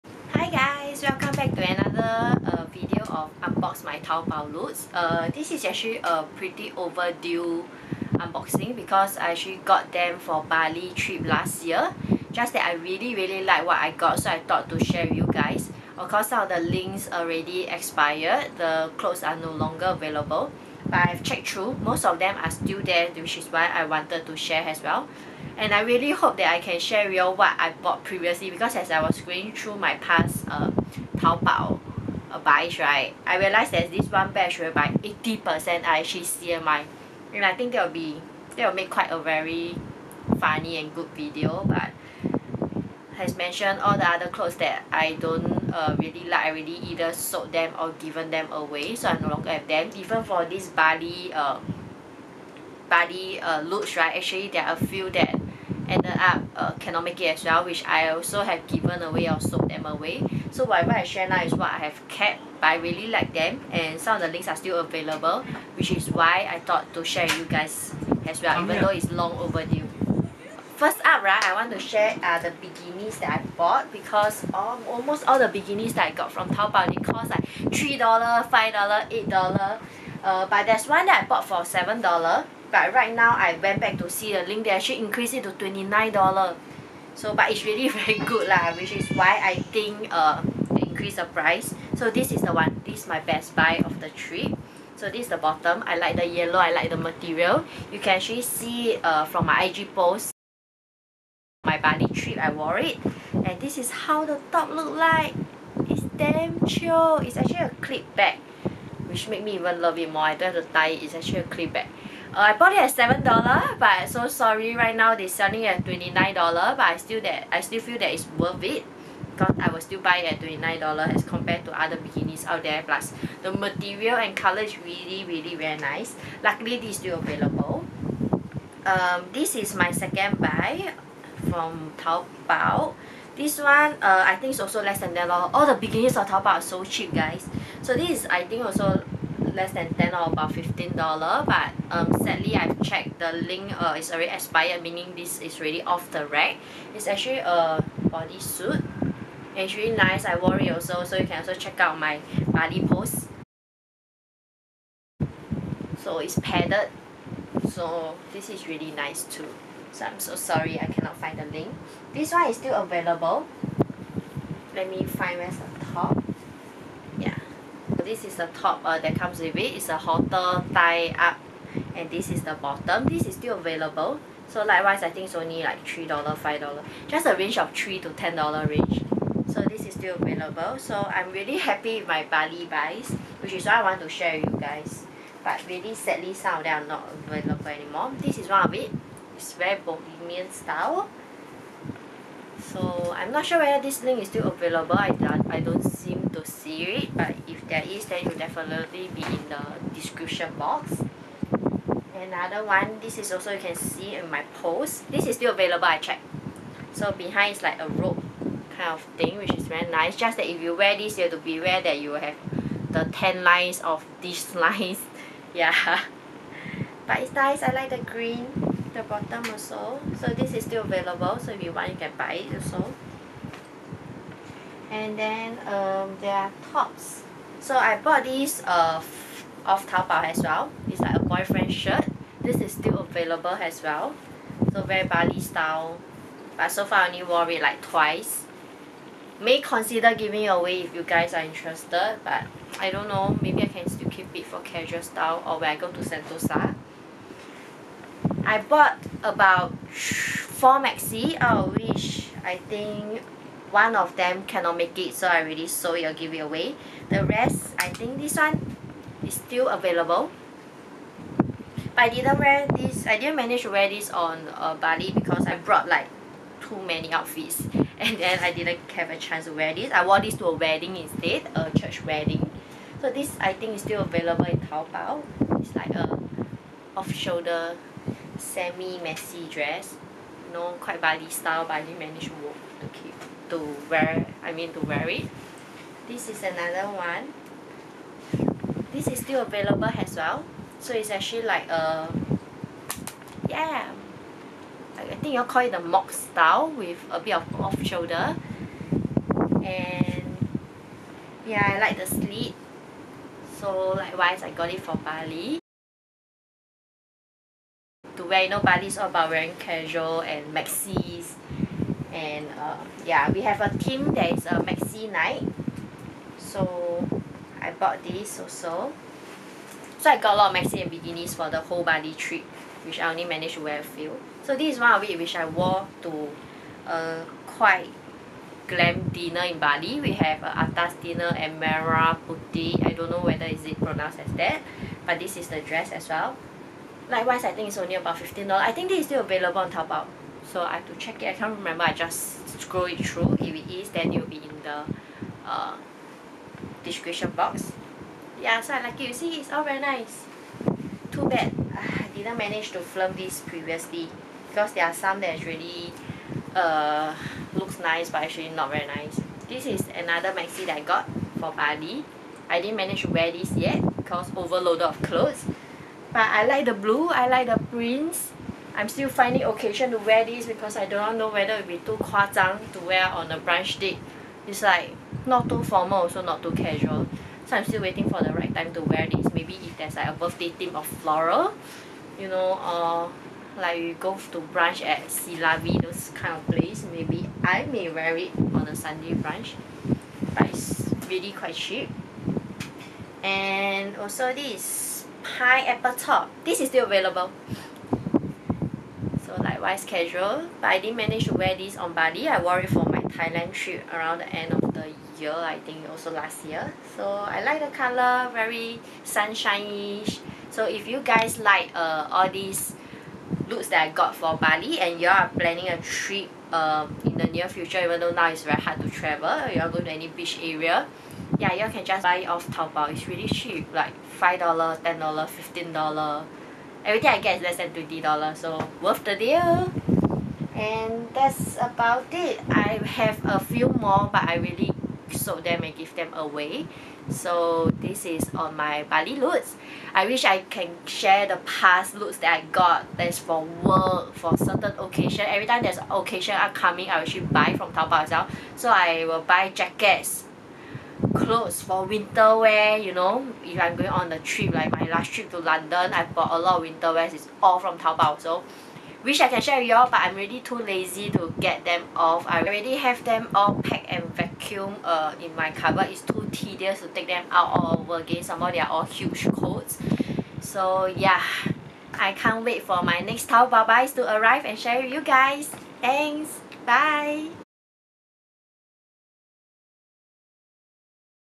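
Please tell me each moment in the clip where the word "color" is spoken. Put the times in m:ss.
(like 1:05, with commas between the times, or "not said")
2:04, 6:47.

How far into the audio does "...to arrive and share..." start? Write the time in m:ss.
7:53.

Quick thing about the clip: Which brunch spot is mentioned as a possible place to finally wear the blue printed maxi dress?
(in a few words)
Silavi.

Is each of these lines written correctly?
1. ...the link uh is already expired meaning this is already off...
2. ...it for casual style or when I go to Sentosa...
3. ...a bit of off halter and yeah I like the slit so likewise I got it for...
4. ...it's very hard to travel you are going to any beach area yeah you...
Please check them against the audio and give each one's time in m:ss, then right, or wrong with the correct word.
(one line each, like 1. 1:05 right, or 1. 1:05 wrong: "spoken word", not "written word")
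1. 2:23 right
2. 4:04 right
3. 4:57 wrong: "shoulder", not "halter"
4. 6:58 right.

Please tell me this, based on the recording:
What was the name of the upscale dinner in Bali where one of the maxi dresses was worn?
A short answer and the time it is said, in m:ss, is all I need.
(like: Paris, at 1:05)
Merah Putih, at 5:31.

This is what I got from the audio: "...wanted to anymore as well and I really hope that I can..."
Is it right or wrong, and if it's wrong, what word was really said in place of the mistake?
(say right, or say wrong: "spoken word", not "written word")
wrong: "share", not "anymore".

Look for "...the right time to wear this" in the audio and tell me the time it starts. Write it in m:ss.
6:18.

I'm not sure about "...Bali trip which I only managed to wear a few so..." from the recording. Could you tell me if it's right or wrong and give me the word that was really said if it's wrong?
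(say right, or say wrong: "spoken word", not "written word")
right.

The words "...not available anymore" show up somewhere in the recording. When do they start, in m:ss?
3:06.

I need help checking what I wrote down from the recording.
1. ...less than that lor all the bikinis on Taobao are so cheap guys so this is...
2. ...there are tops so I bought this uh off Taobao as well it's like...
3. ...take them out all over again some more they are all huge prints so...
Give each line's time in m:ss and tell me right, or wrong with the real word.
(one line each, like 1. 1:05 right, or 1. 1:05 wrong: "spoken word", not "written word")
1. 2:14 right
2. 3:46 right
3. 7:46 wrong: "coats", not "prints".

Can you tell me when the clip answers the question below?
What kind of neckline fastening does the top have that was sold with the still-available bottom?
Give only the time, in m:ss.
2:49.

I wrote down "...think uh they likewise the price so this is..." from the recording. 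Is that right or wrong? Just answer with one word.
wrong.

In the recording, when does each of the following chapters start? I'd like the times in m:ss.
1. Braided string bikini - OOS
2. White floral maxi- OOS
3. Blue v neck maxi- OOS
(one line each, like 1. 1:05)
1. 3:24
2. 4:18
3. 6:00.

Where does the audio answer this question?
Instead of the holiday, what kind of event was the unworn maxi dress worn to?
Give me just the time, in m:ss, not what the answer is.
4:31.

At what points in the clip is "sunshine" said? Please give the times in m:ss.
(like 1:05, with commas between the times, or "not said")
6:49.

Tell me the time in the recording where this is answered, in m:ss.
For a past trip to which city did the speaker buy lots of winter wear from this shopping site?
7:35.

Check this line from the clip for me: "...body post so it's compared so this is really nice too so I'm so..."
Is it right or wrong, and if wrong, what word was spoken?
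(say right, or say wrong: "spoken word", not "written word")
wrong: "padded", not "compared".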